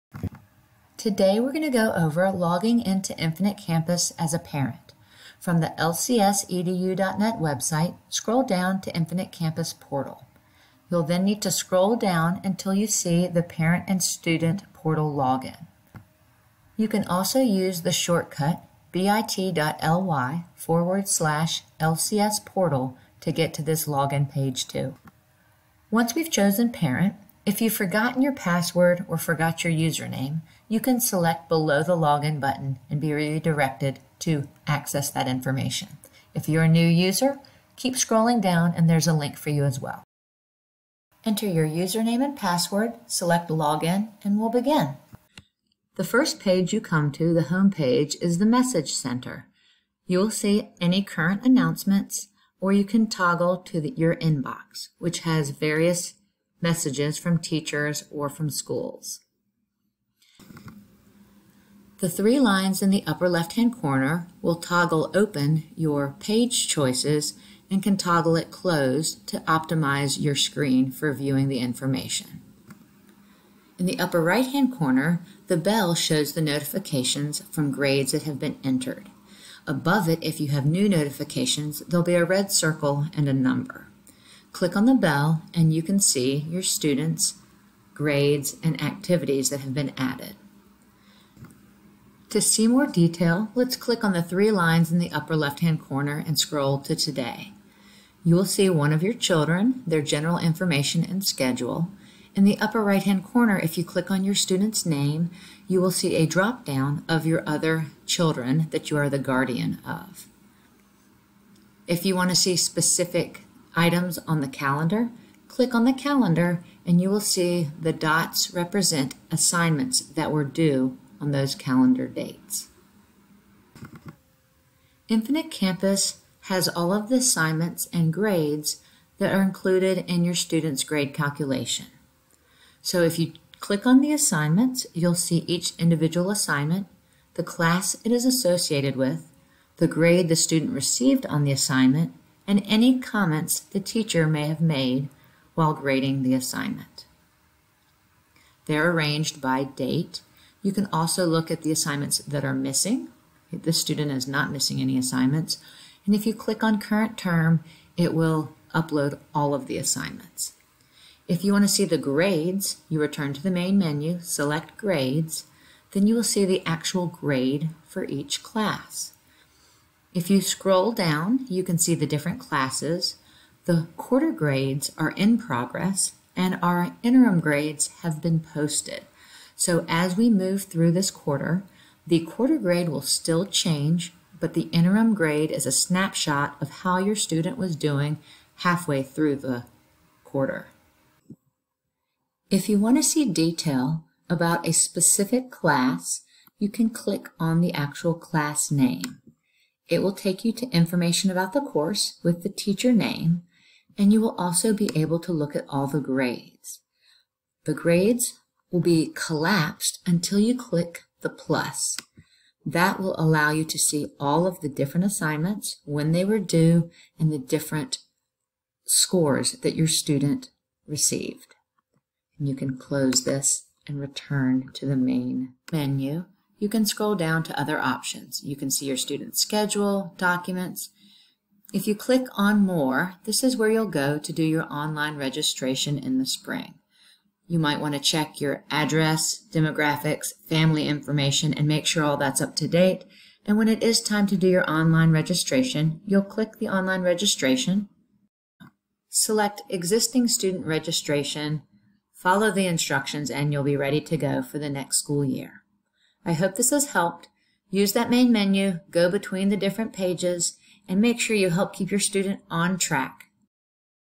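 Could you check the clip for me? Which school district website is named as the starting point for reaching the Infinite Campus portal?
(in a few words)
lcsedu.net.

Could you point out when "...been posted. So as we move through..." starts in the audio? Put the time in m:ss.
2:58.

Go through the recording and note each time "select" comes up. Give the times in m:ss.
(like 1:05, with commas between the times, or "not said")
0:31, 0:43, 2:44, 4:09.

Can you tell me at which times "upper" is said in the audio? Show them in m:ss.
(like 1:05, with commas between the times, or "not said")
1:03, 1:13, 1:35, 1:42.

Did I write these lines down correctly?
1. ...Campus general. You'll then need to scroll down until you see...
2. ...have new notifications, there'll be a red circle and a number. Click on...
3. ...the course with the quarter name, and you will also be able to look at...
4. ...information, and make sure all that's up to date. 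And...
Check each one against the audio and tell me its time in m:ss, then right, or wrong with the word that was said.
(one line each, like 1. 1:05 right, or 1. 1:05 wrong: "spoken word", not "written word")
1. 0:09 wrong: "portal", not "general"
2. 1:20 right
3. 3:21 wrong: "teacher", not "quarter"
4. 4:00 right.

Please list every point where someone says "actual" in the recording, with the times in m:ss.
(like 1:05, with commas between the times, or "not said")
2:46, 3:17.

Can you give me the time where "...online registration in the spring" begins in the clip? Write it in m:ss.
3:54.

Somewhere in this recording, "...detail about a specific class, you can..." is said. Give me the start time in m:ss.
3:13.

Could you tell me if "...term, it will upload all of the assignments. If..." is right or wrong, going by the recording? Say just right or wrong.
right.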